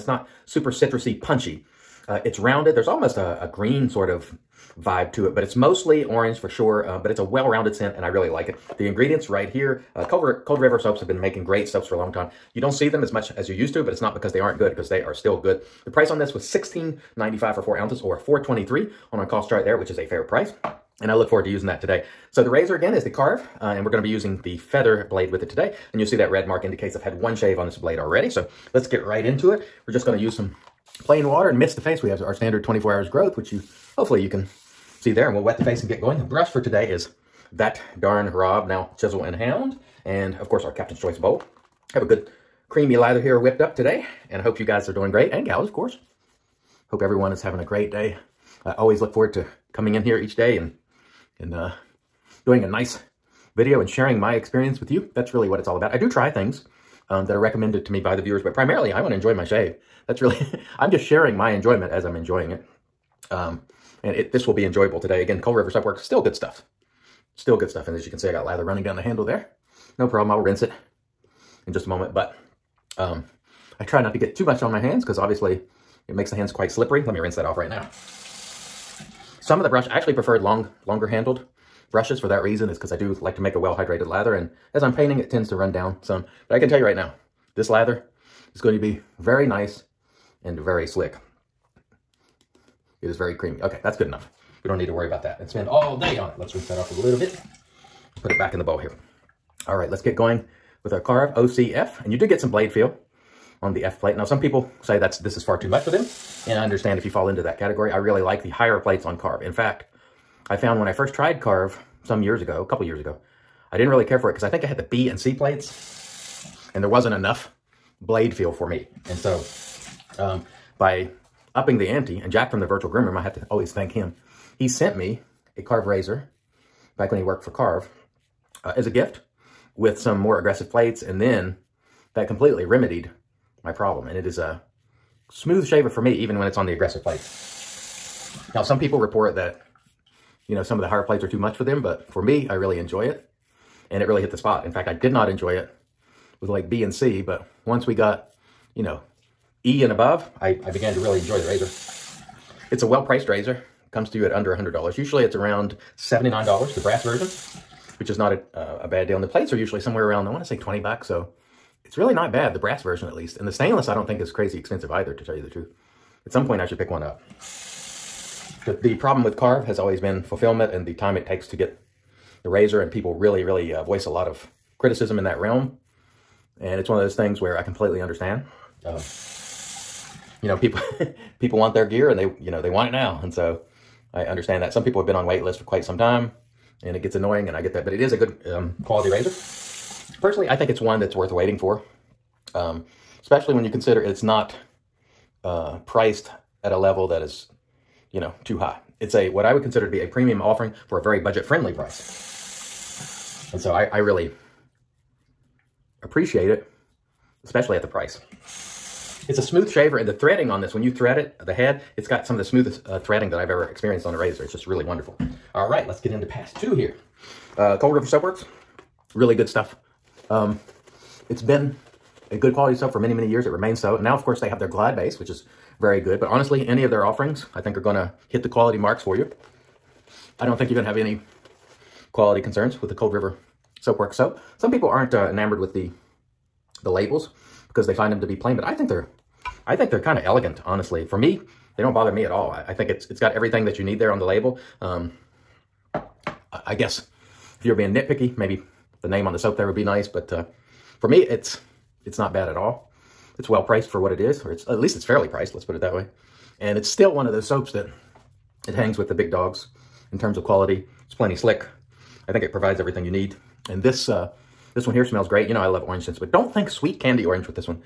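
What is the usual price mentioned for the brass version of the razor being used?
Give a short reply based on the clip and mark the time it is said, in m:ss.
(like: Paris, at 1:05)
$79, at 2:35.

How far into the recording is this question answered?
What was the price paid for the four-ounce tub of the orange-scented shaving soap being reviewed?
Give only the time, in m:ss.
0:16.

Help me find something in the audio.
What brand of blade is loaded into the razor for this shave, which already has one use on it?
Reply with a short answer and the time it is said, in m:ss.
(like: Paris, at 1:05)
Feather, at 0:24.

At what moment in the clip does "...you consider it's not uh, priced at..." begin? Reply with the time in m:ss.
3:13.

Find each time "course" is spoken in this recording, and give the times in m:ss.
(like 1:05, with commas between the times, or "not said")
0:40, 0:45, 3:44.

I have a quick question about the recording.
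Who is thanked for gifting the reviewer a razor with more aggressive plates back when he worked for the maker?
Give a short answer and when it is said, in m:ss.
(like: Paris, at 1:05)
Jack, at 2:02.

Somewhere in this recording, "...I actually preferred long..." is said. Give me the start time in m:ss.
1:19.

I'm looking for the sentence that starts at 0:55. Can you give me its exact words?
That's really what it's all about.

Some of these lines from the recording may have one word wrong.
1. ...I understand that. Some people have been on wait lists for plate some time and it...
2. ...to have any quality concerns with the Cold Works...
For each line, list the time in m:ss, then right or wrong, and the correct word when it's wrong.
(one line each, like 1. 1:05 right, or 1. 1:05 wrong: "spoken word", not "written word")
1. 3:04 wrong: "quite", not "plate"
2. 3:50 wrong: "River", not "Works".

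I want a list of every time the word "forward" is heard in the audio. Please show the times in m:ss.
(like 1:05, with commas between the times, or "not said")
0:21, 0:49.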